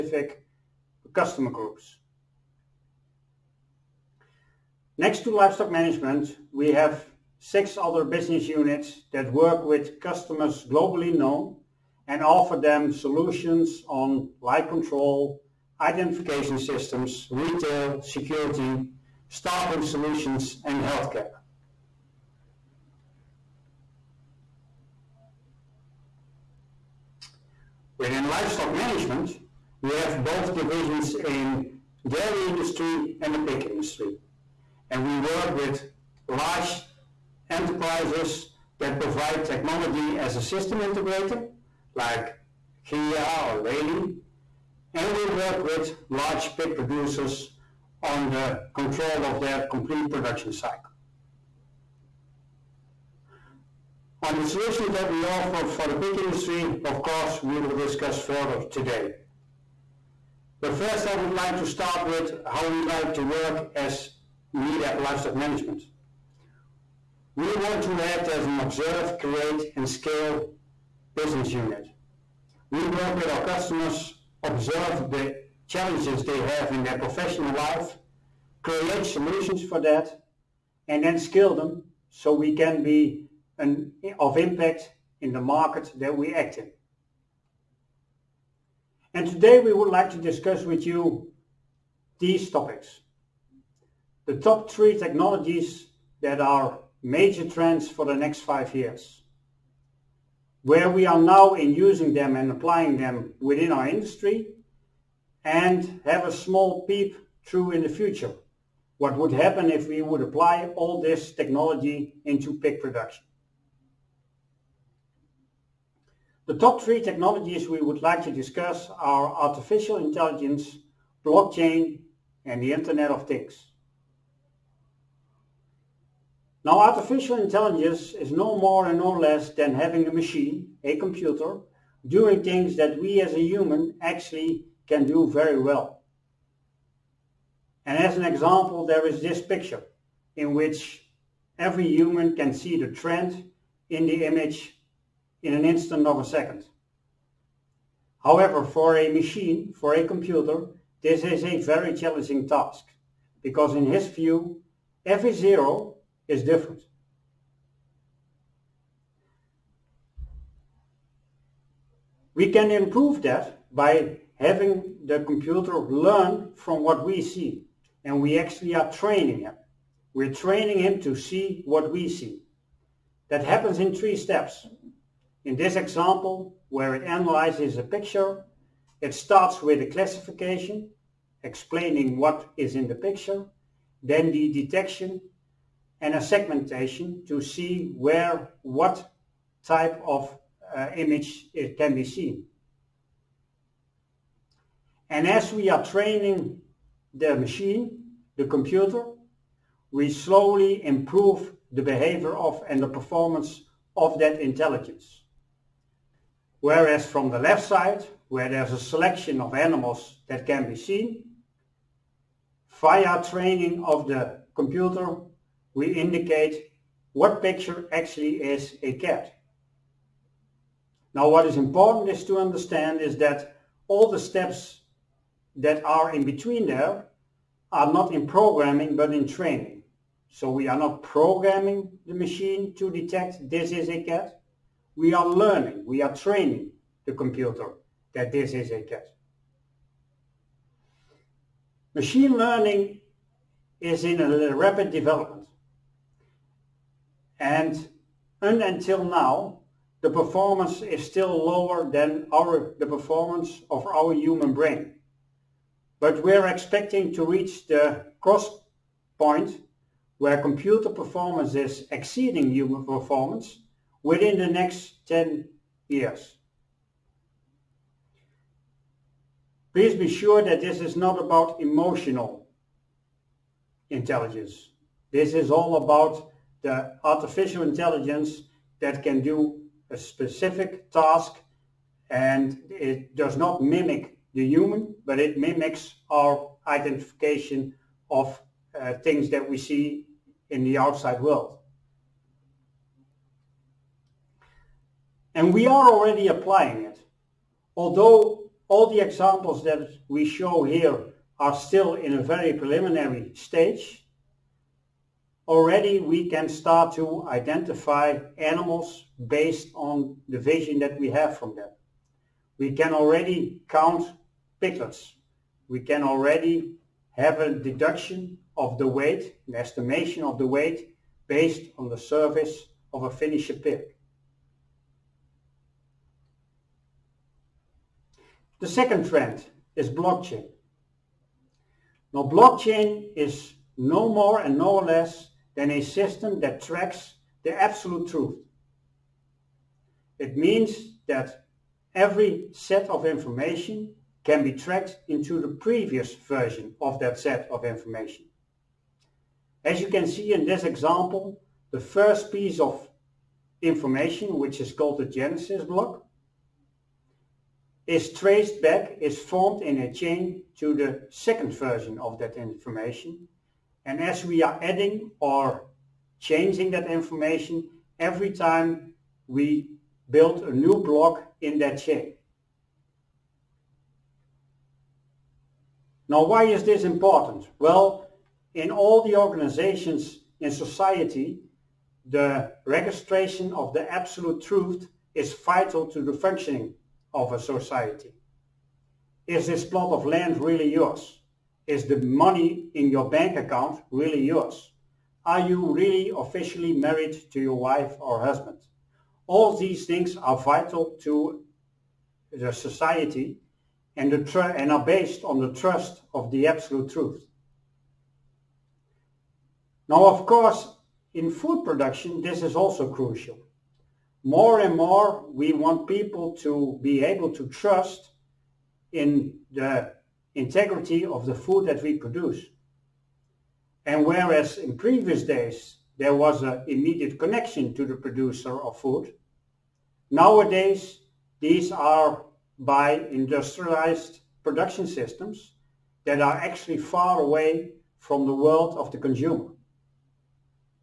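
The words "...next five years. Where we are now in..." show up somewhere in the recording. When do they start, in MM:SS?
01:38.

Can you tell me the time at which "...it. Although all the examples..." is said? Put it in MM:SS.
04:56.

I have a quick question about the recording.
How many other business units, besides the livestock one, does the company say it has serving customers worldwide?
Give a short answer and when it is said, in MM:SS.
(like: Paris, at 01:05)
6, at 00:07.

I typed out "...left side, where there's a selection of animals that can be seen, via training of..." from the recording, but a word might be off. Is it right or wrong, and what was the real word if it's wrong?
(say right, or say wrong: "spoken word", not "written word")
right.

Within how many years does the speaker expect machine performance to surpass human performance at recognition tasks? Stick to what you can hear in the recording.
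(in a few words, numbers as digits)
10.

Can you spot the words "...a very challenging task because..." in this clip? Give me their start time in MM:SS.
02:31.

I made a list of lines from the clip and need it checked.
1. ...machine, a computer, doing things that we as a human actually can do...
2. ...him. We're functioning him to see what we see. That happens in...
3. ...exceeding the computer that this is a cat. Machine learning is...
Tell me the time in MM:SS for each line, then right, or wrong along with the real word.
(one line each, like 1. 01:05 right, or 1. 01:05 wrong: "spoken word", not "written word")
1. 02:10 right
2. 02:49 wrong: "training", not "functioning"
3. 03:56 wrong: "training", not "exceeding".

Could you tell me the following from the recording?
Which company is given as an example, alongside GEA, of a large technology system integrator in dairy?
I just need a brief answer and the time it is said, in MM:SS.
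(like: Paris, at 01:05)
Lely, at 00:43.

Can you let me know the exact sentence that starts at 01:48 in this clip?
What would happen if we would apply all this technology into pig production.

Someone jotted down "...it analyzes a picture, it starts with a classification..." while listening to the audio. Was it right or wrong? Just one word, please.
right.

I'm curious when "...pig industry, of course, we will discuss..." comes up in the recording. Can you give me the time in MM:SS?
00:55.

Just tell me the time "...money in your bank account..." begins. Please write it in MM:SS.
06:32.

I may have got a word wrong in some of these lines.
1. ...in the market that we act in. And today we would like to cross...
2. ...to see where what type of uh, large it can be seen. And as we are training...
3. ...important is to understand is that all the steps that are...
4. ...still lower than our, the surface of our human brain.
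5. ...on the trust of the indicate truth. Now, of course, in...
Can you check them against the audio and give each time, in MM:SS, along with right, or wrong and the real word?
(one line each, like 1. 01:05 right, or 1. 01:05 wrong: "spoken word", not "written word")
1. 01:25 wrong: "discuss", not "cross"
2. 03:07 wrong: "image", not "large"
3. 03:41 right
4. 04:11 wrong: "performance", not "surface"
5. 06:45 wrong: "absolute", not "indicate".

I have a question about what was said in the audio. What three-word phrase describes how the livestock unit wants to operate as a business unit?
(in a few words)
observe, create and scale.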